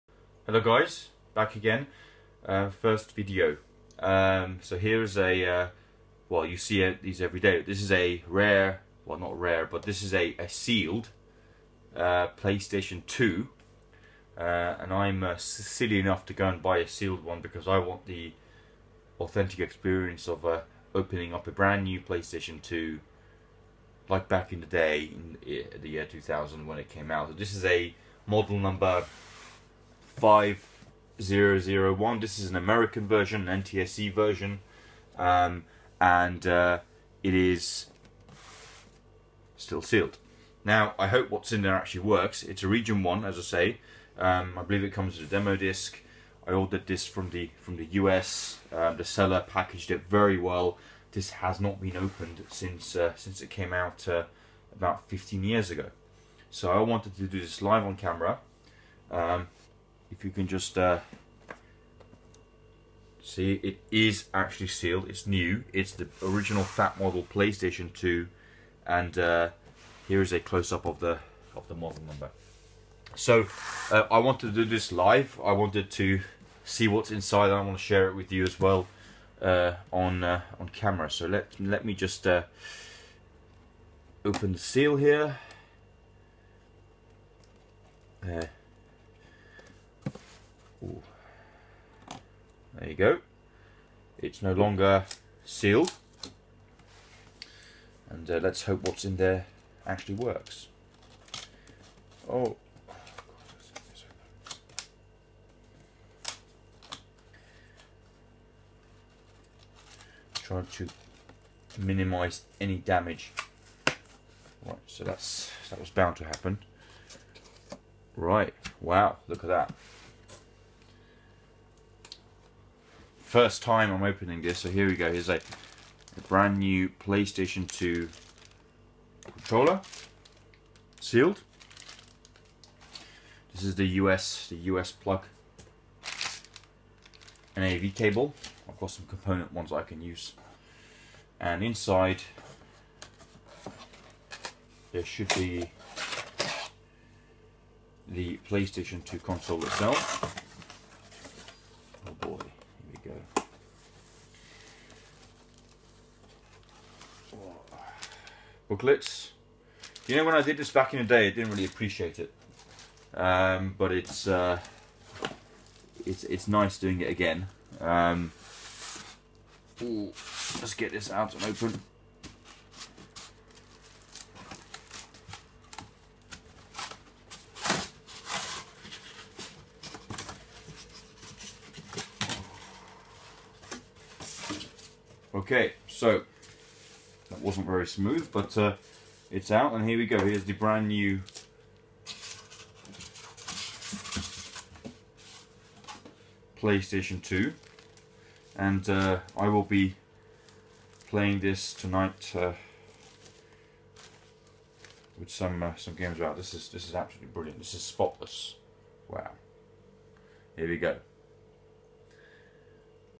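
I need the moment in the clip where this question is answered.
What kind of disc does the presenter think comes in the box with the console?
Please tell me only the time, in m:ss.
0:45.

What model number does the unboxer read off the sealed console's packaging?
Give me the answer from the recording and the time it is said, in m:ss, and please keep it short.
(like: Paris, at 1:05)
5001, at 0:30.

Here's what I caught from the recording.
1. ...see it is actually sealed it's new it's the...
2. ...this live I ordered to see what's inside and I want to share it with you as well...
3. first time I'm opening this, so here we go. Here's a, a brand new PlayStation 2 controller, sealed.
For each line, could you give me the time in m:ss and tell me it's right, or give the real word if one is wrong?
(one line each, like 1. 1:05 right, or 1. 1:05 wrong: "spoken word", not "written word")
1. 1:03 right
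2. 1:14 wrong: "wanted", not "ordered"
3. 2:03 right.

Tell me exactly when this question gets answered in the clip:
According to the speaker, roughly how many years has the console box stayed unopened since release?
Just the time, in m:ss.
0:55.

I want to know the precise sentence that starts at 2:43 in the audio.
Um, but it's, uh, it's, it's nice doing it again.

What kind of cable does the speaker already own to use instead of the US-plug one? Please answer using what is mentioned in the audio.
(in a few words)
component.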